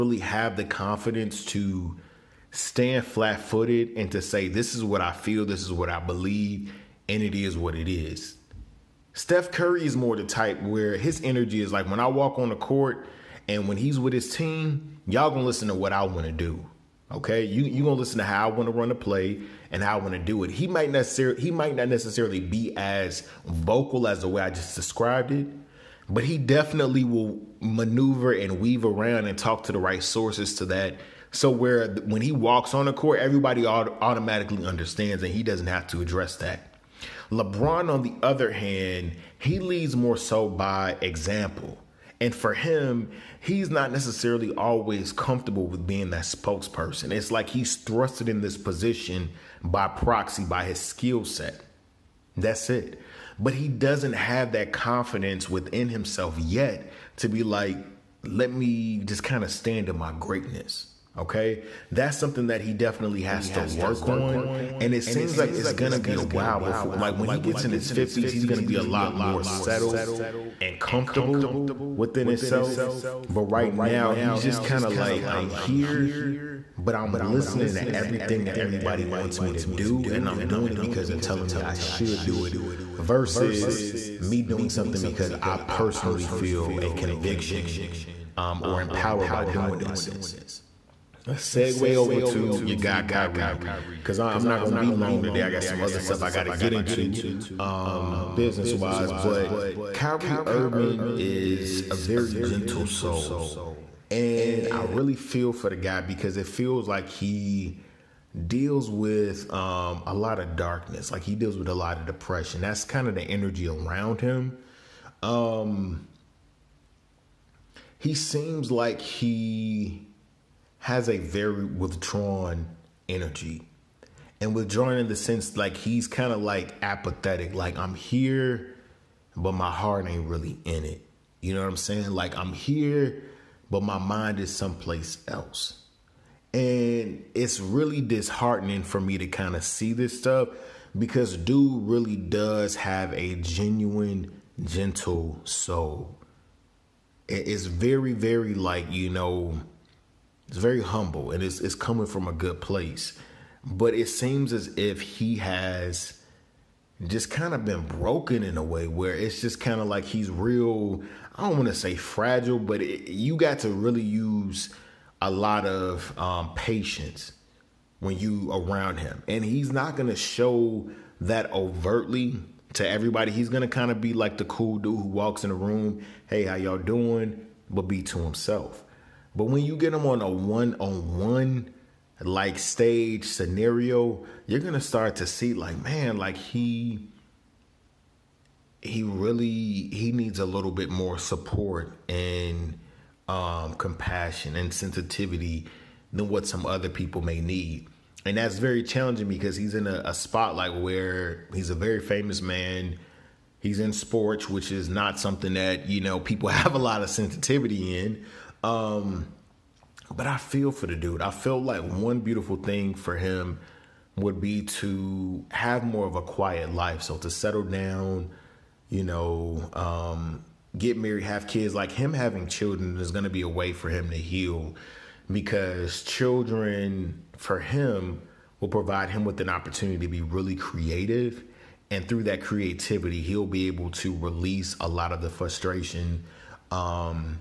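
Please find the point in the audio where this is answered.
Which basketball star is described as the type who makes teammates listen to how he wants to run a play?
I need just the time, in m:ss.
0:09.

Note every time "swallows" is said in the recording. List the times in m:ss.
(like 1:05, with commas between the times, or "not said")
not said.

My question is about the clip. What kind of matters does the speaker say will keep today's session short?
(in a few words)
Business.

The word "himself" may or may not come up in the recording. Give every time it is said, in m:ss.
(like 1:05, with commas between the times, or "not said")
0:55, 1:12, 2:58.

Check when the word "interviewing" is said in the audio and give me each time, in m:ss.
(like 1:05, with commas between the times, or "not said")
not said.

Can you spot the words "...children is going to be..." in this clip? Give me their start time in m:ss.
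3:42.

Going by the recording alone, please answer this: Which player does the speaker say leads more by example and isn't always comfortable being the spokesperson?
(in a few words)
LeBron.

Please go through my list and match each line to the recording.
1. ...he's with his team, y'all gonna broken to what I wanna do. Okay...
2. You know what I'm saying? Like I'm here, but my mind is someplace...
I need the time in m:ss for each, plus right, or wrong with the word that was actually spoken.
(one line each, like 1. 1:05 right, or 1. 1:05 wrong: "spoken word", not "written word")
1. 0:13 wrong: "listen", not "broken"
2. 2:11 right.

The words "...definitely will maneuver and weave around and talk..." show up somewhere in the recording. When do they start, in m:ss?
0:26.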